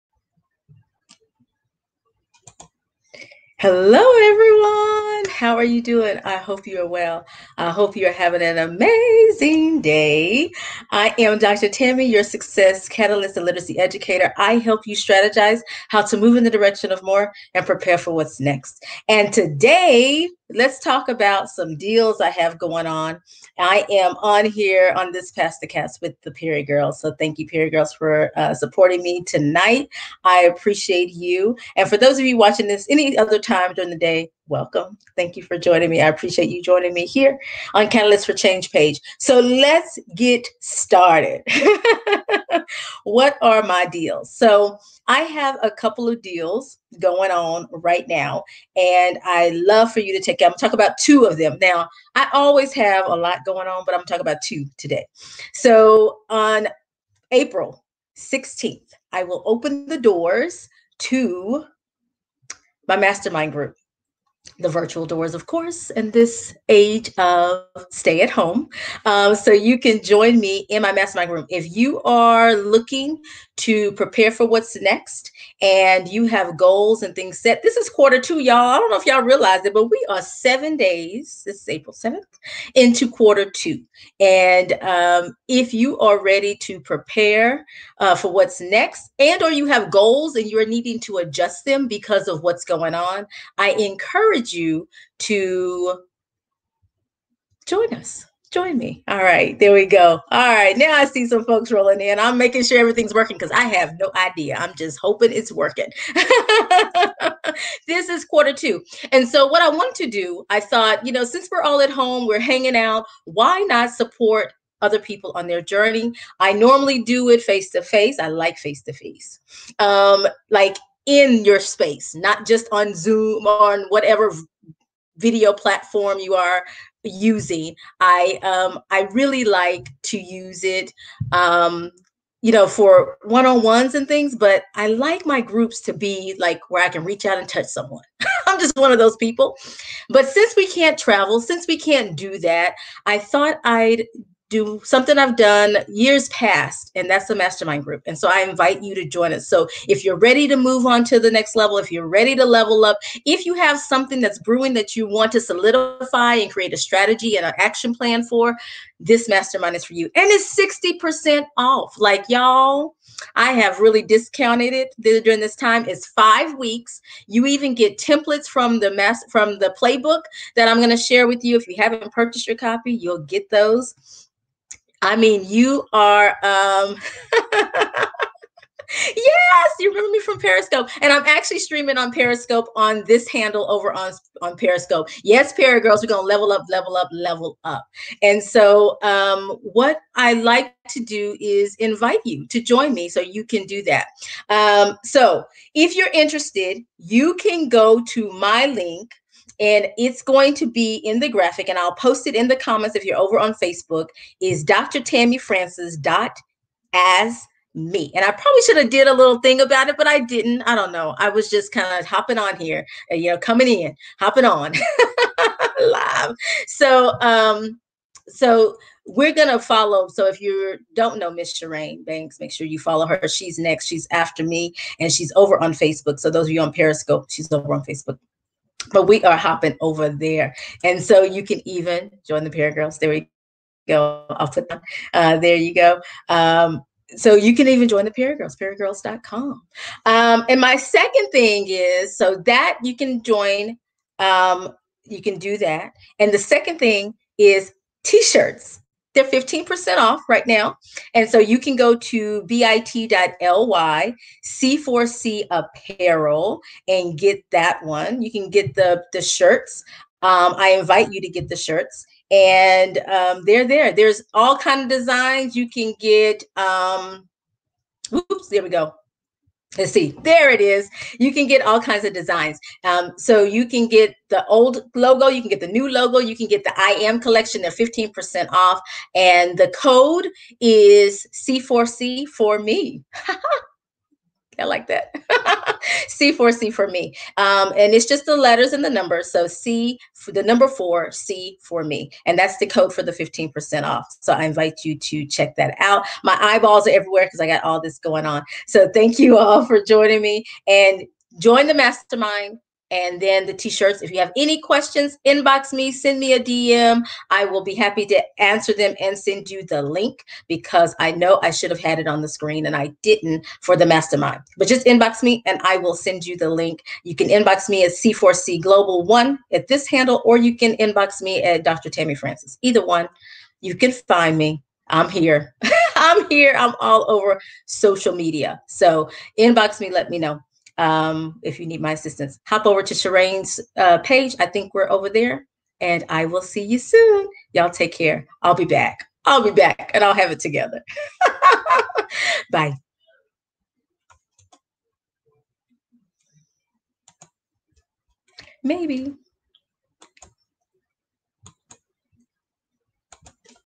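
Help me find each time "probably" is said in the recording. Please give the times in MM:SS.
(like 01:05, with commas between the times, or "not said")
03:28.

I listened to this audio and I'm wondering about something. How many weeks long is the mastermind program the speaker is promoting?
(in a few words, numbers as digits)
5.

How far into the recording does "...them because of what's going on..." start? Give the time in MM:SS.
01:31.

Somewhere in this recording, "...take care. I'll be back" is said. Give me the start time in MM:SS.
05:37.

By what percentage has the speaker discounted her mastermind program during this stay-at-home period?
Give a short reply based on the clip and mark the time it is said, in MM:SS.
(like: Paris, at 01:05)
60%, at 02:40.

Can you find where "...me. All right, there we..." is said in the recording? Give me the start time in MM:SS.
01:38.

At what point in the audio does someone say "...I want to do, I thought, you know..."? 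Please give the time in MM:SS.
01:49.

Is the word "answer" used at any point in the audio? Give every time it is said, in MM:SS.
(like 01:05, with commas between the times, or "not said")
05:08.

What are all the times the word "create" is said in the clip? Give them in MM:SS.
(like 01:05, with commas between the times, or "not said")
02:36.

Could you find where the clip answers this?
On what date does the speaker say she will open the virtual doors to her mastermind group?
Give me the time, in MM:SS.
00:57.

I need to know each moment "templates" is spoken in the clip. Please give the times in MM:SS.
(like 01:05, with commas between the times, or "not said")
02:47.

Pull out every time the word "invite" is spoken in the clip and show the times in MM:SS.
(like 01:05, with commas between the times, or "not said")
02:28, 03:11, 04:20, 04:54.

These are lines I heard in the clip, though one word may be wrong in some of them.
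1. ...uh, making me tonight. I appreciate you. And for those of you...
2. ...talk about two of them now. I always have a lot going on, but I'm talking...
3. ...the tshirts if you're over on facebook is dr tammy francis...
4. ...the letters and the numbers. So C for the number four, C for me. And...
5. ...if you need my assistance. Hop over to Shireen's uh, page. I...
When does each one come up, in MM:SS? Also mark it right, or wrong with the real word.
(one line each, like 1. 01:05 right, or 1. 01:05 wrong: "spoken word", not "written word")
1. 00:28 wrong: "supporting", not "making"
2. 00:50 right
3. 03:22 wrong: "comments", not "tshirts"
4. 04:48 right
5. 05:31 right.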